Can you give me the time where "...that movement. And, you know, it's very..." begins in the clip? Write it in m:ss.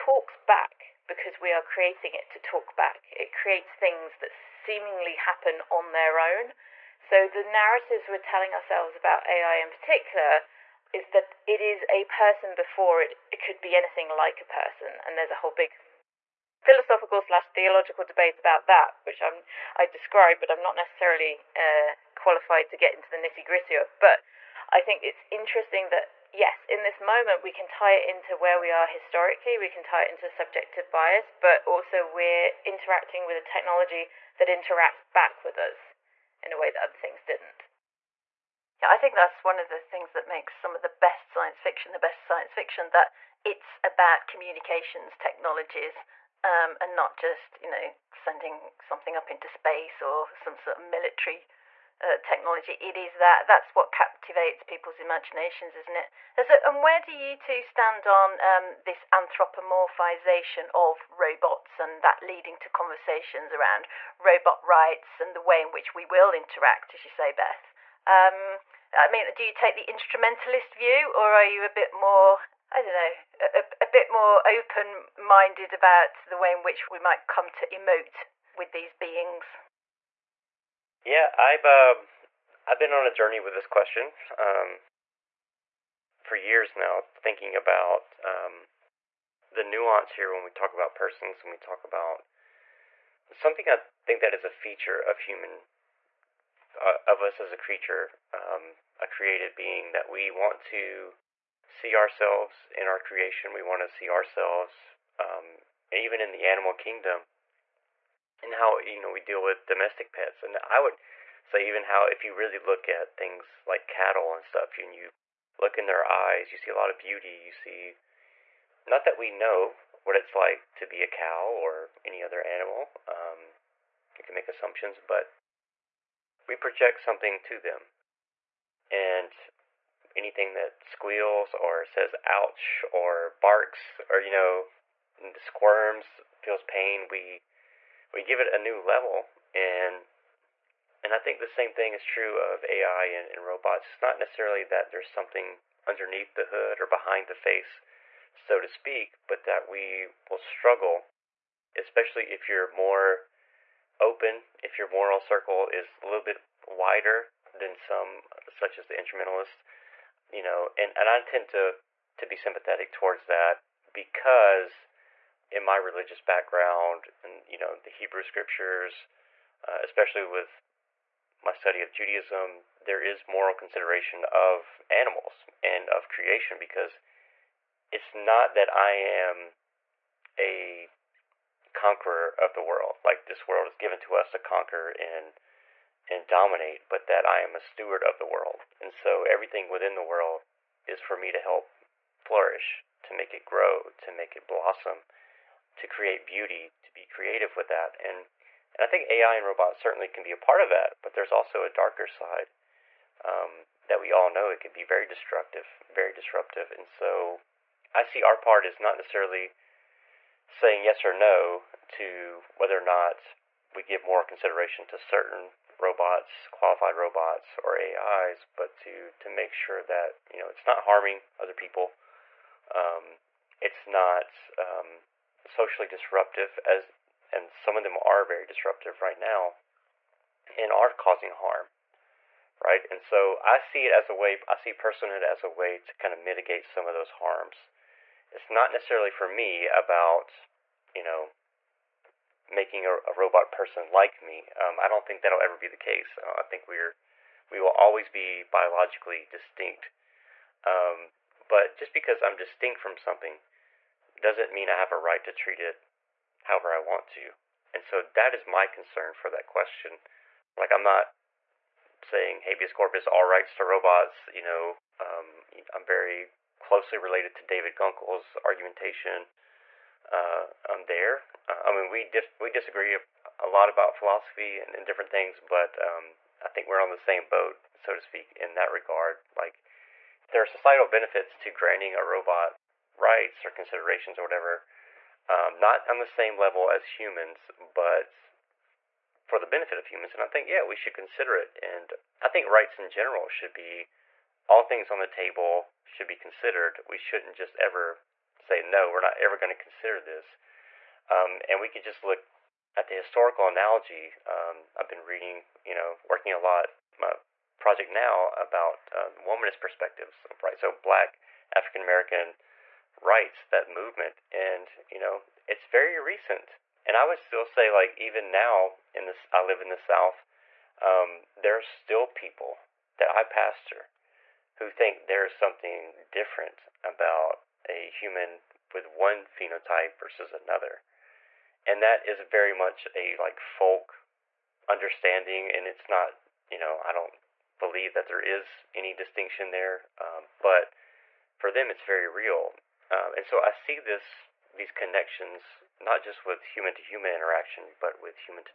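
5:13.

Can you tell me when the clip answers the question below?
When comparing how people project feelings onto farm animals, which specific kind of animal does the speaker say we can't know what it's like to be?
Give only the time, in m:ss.
2:01.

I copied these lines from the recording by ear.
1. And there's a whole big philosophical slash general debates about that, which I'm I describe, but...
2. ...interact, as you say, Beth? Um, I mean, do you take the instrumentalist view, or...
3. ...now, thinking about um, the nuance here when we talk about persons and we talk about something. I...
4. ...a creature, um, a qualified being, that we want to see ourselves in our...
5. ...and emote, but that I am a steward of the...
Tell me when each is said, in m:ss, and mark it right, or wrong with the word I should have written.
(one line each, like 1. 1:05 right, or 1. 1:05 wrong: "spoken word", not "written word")
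1. 0:15 wrong: "theological", not "general"
2. 1:06 right
3. 1:26 right
4. 1:37 wrong: "created", not "qualified"
5. 3:06 wrong: "dominate", not "emote".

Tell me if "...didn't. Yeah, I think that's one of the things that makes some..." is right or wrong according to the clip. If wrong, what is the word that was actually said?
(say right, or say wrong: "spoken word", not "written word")
right.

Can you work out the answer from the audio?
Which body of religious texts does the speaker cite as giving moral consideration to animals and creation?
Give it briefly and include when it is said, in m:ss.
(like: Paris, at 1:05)
Hebrew scriptures, at 2:47.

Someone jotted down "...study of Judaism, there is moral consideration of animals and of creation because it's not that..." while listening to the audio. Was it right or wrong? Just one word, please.
right.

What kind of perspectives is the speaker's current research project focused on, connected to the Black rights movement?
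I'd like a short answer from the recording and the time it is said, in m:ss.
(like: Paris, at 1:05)
womanist perspectives, at 5:09.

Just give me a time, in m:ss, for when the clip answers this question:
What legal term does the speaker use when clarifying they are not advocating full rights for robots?
4:22.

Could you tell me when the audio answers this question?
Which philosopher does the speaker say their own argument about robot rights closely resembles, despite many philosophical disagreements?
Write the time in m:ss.
4:27.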